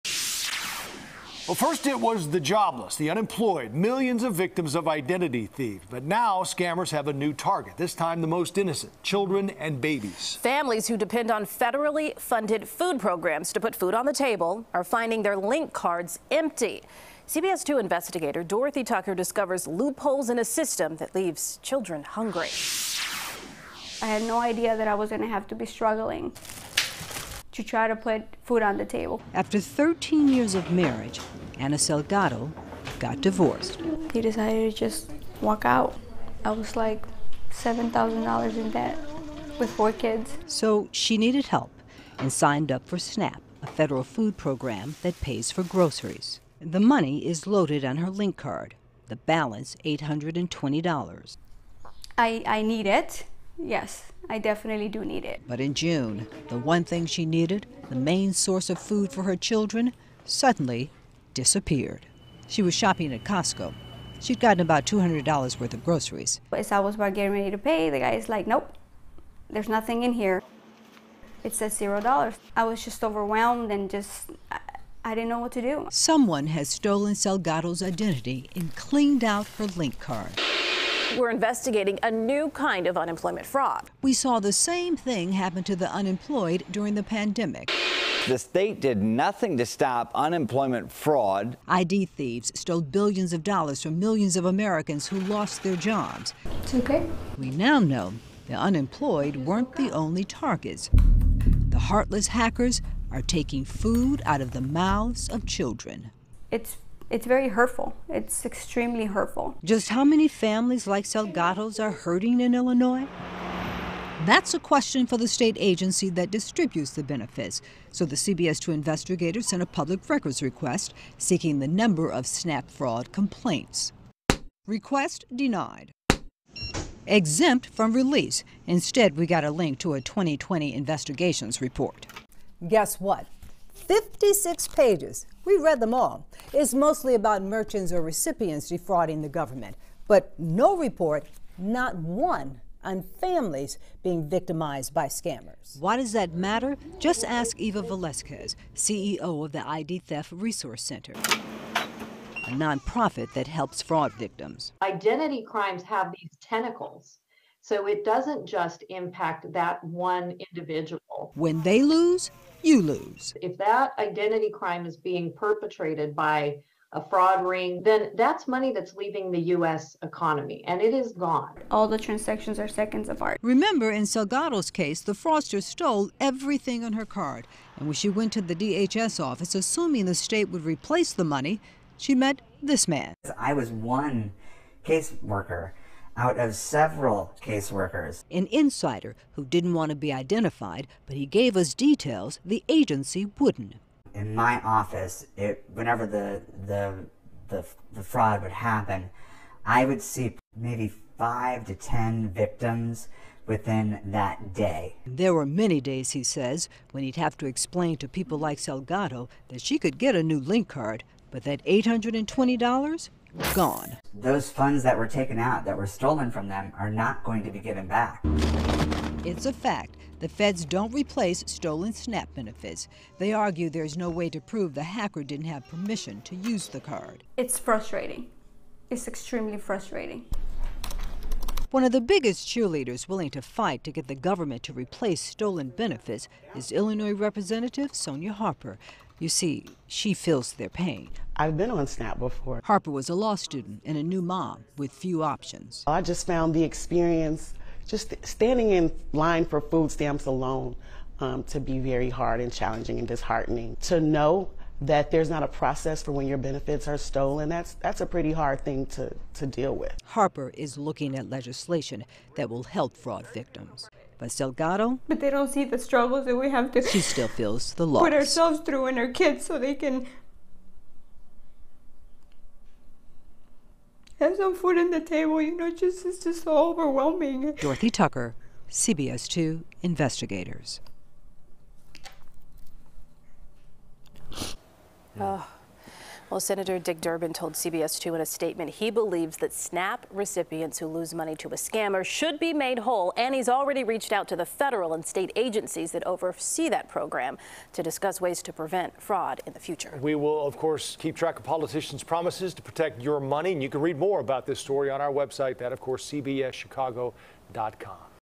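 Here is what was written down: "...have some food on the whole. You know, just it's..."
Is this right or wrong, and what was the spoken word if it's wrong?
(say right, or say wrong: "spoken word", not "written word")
wrong: "table", not "whole".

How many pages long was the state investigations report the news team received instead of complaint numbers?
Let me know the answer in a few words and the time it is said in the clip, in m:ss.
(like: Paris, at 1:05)
56, at 2:13.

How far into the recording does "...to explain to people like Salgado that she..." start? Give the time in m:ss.
3:27.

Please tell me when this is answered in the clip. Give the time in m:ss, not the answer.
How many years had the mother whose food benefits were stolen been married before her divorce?
0:29.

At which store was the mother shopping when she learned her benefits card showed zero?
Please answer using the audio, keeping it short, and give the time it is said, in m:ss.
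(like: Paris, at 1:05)
Costco, at 1:03.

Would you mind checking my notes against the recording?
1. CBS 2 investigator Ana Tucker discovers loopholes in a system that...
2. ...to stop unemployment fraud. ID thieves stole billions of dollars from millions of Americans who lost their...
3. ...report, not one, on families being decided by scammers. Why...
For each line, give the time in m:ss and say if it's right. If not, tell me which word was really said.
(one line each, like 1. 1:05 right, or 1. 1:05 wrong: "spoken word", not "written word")
1. 0:17 wrong: "Dorothy", not "Ana"
2. 1:29 right
3. 2:20 wrong: "victimized", not "decided".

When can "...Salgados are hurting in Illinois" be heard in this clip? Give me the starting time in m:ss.
1:51.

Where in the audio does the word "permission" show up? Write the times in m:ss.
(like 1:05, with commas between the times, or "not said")
3:45.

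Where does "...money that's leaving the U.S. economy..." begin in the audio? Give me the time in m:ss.
2:48.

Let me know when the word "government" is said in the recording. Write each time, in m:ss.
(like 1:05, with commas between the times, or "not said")
2:19, 3:54.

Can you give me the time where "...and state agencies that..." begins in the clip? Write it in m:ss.
4:54.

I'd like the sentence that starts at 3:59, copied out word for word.
You see, she feels their pain.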